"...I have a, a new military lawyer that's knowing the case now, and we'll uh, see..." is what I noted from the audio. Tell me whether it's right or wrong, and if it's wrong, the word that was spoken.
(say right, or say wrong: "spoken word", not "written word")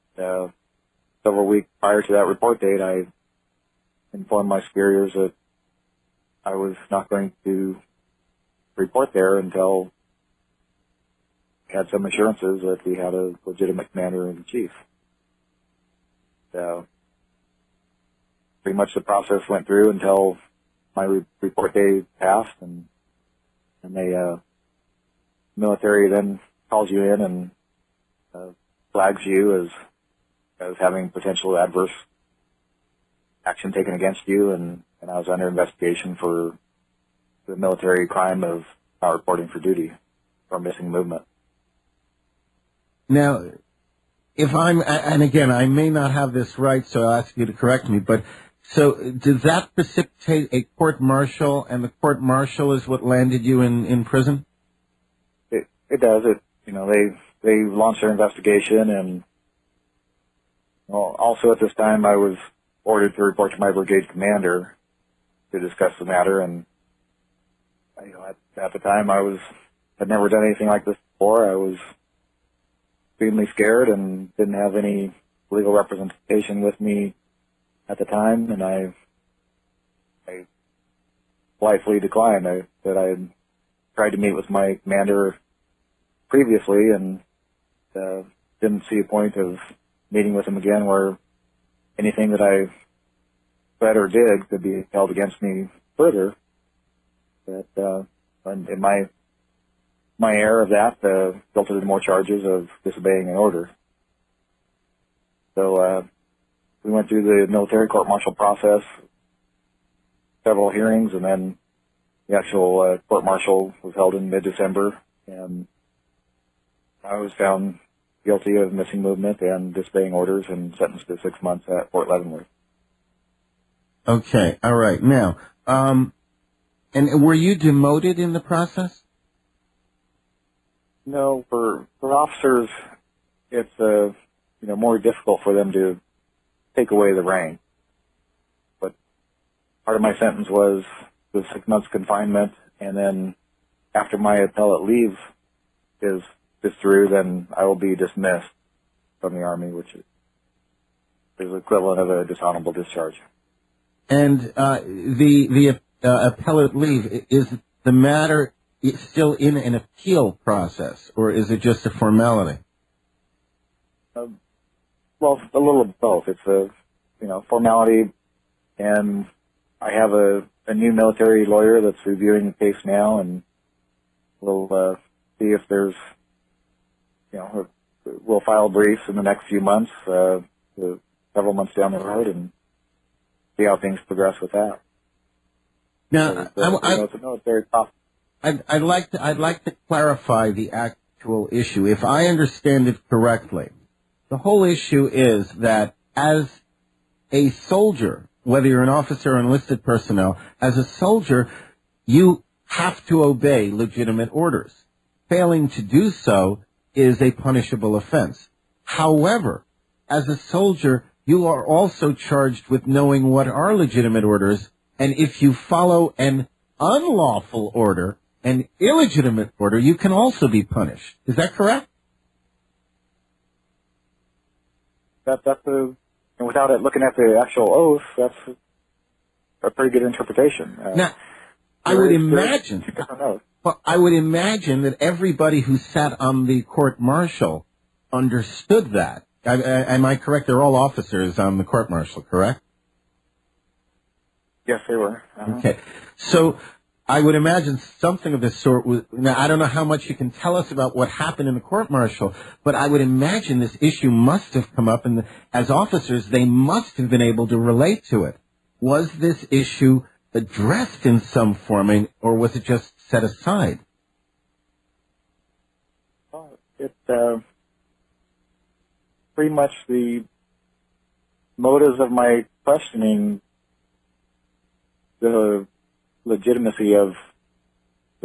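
wrong: "reviewing", not "knowing".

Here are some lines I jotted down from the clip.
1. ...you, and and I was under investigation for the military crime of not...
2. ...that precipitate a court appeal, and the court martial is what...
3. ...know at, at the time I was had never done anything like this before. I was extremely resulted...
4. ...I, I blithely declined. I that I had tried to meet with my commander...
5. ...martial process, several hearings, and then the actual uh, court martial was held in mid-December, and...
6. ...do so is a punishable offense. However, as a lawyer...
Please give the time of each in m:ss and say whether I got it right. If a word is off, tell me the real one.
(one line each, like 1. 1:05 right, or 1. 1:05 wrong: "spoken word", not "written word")
1. 0:34 right
2. 0:49 wrong: "martial", not "appeal"
3. 1:08 wrong: "scared", not "resulted"
4. 1:18 right
5. 1:48 right
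6. 3:25 wrong: "soldier", not "lawyer".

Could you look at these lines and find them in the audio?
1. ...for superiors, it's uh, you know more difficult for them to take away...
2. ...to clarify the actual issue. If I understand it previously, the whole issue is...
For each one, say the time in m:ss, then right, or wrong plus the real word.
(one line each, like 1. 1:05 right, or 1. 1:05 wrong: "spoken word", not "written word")
1. 2:11 wrong: "officers", not "superiors"
2. 3:09 wrong: "correctly", not "previously".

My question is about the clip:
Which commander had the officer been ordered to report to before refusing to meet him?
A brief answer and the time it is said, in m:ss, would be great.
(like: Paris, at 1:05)
Brigade commander, at 1:03.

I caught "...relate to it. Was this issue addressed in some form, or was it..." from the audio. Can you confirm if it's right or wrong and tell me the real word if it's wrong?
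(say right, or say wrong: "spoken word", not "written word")
right.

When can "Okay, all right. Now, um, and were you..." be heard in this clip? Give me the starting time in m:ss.
2:04.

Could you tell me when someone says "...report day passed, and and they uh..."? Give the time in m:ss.
0:21.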